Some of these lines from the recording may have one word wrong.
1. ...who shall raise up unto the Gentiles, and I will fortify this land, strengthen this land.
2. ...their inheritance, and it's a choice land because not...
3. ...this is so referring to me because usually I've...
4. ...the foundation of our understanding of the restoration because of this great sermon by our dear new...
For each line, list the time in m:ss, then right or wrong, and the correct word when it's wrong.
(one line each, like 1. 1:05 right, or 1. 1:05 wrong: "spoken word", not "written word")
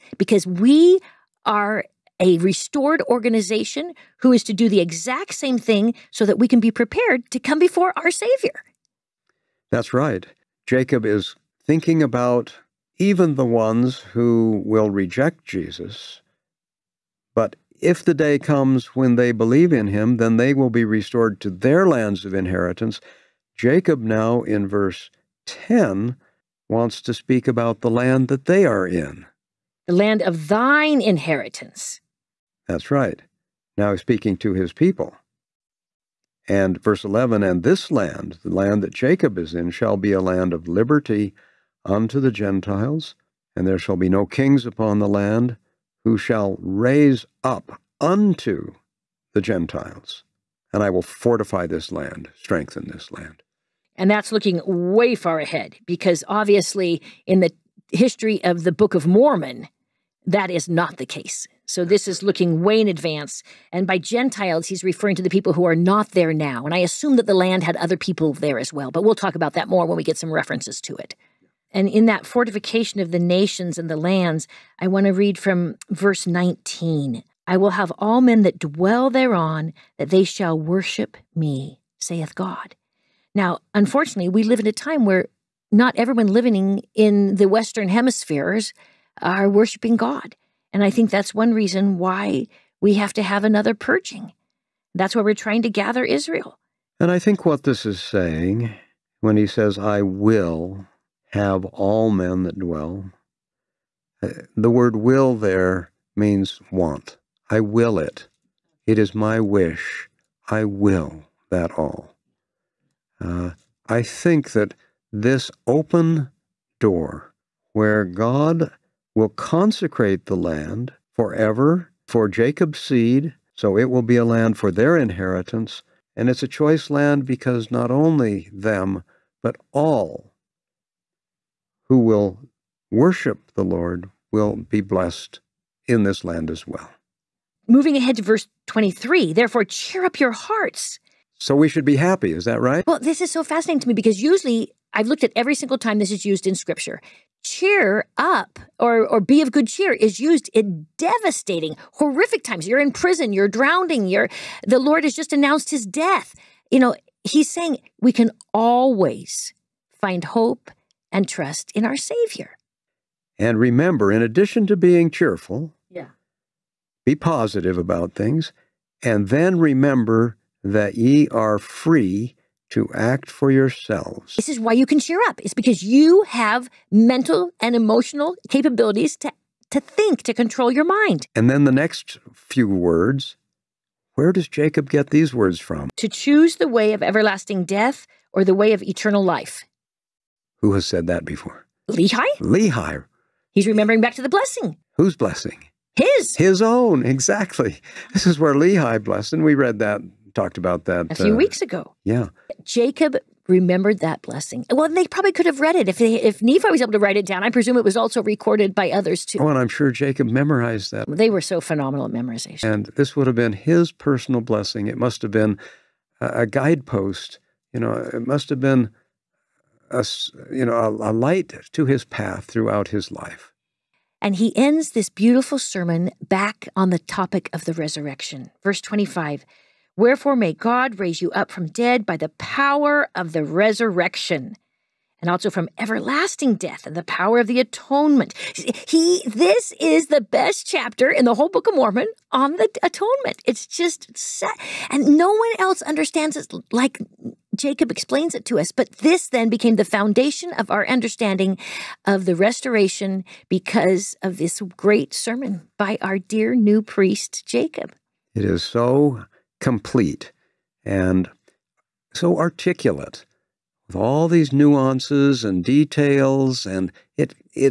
1. 0:46 right
2. 2:04 right
3. 2:23 wrong: "fascinating", not "referring"
4. 4:09 right.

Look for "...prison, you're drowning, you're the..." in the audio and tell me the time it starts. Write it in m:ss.
2:32.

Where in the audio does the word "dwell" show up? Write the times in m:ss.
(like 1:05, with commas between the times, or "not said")
1:18, 1:42.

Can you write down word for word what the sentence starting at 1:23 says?
Now, unfortunately, we live in a time where not everyone living in the Western hemispheres are worshiping God.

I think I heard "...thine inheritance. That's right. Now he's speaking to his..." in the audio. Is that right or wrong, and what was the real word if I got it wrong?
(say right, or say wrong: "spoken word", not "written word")
right.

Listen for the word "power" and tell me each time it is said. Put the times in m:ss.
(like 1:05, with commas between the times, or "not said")
3:52, 3:57.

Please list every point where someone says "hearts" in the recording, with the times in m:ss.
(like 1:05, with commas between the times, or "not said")
2:20.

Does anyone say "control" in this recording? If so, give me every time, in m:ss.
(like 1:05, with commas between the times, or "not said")
3:00.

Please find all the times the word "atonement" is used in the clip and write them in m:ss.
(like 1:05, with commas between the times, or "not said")
3:57, 4:02.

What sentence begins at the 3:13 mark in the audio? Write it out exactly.
He's remembering back to the blessing.